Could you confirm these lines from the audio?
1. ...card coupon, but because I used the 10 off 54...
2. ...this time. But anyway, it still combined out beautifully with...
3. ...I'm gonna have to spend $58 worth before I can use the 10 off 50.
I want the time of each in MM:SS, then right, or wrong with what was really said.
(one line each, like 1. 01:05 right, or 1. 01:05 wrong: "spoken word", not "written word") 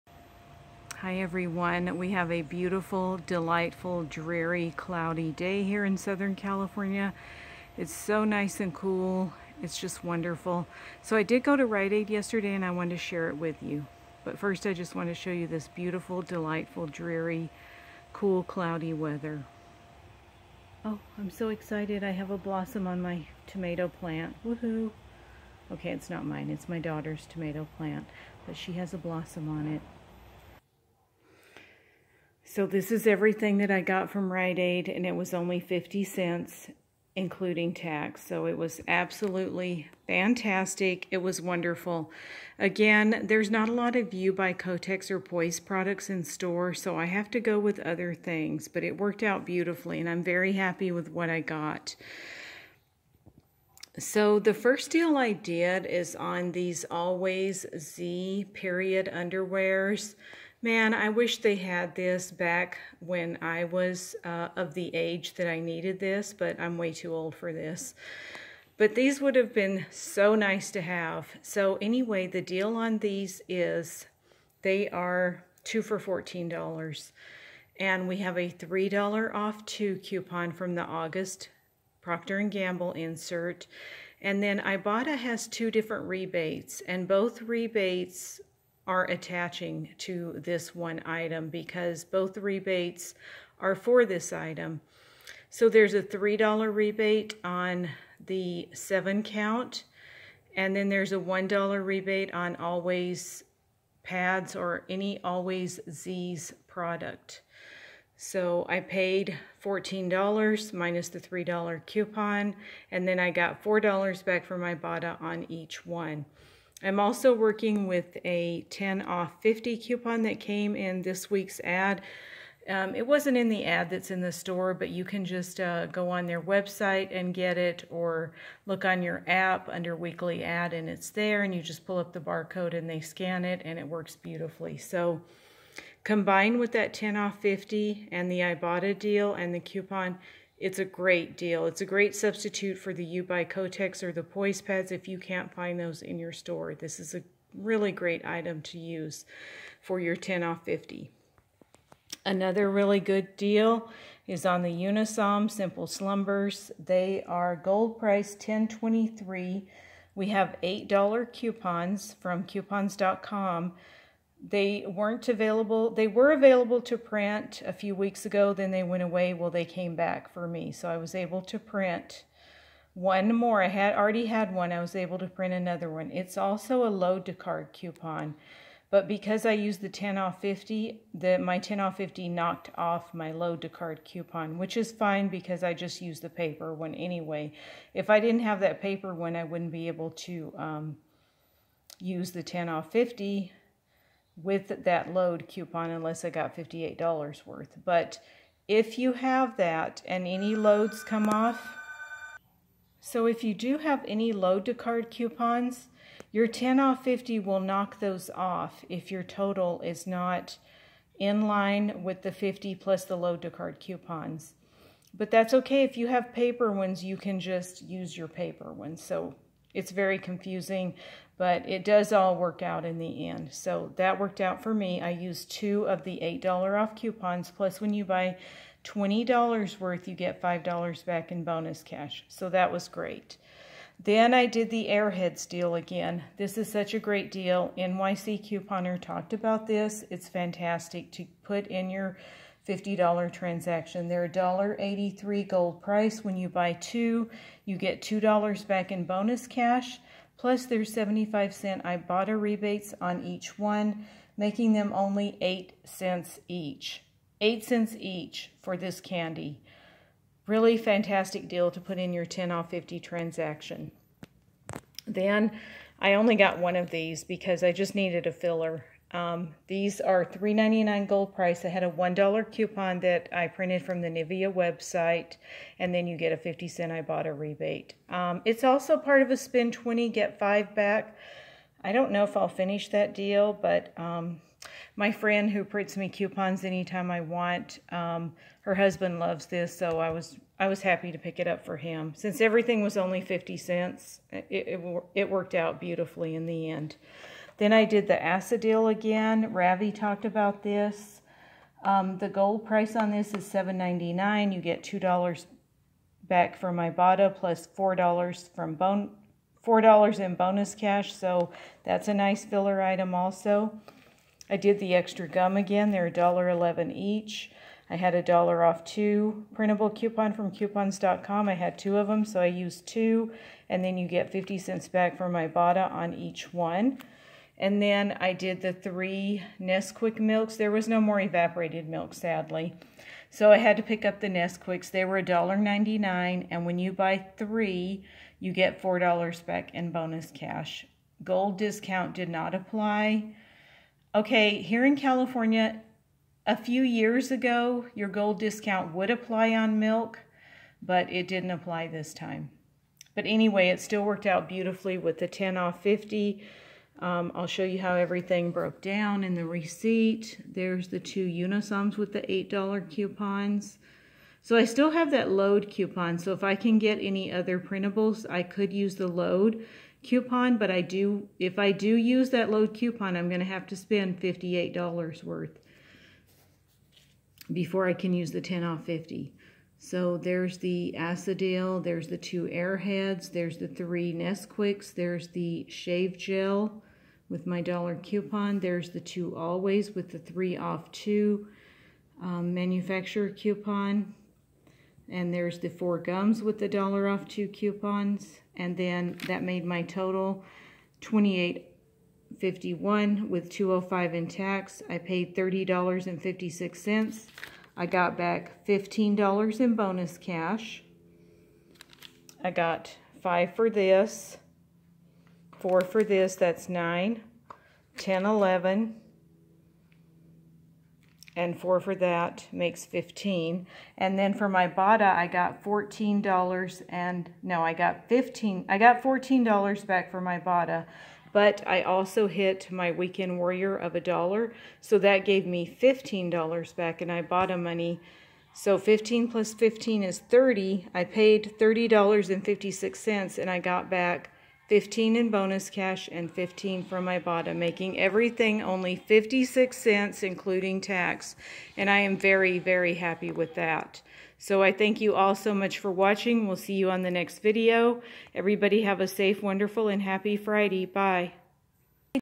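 1. 02:57 wrong: "50", not "54"
2. 05:51 wrong: "worked", not "combined"
3. 06:13 right.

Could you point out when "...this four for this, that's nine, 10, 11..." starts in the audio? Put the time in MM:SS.
06:53.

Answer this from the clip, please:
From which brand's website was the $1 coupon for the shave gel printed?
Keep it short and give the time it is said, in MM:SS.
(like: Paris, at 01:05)
Nivea, at 04:34.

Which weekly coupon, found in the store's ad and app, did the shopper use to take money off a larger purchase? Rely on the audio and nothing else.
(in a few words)
10 off 50.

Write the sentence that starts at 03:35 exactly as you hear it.
But that's okay if you have paper ones, you can just use your paper ones.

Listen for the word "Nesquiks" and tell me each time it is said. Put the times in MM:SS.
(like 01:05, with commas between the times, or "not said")
05:29, 05:34, 06:24.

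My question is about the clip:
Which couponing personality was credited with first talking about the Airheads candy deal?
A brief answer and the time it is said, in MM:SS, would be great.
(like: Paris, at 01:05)
NYC Couponer, at 03:57.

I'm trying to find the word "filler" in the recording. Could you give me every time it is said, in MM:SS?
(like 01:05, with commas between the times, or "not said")
04:28, 05:12.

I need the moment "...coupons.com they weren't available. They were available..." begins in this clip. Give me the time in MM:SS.
02:42.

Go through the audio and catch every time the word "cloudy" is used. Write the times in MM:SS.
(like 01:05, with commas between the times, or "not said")
00:04, 00:18.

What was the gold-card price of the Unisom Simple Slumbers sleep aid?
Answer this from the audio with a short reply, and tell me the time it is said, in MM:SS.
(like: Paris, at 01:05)
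$10.23, at 02:38.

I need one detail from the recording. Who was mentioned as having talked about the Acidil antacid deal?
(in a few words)
Ravi.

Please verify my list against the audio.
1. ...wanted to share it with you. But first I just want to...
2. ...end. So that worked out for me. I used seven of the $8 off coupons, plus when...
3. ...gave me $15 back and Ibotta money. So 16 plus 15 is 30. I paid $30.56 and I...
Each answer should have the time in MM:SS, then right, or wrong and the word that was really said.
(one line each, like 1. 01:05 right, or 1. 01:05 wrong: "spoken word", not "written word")
1. 00:12 right
2. 03:43 wrong: "two", not "seven"
3. 07:15 wrong: "15", not "16".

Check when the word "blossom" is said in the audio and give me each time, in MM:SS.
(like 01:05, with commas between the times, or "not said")
00:22, 00:28.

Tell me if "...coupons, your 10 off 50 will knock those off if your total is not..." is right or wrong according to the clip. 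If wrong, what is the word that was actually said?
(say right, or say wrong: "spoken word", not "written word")
right.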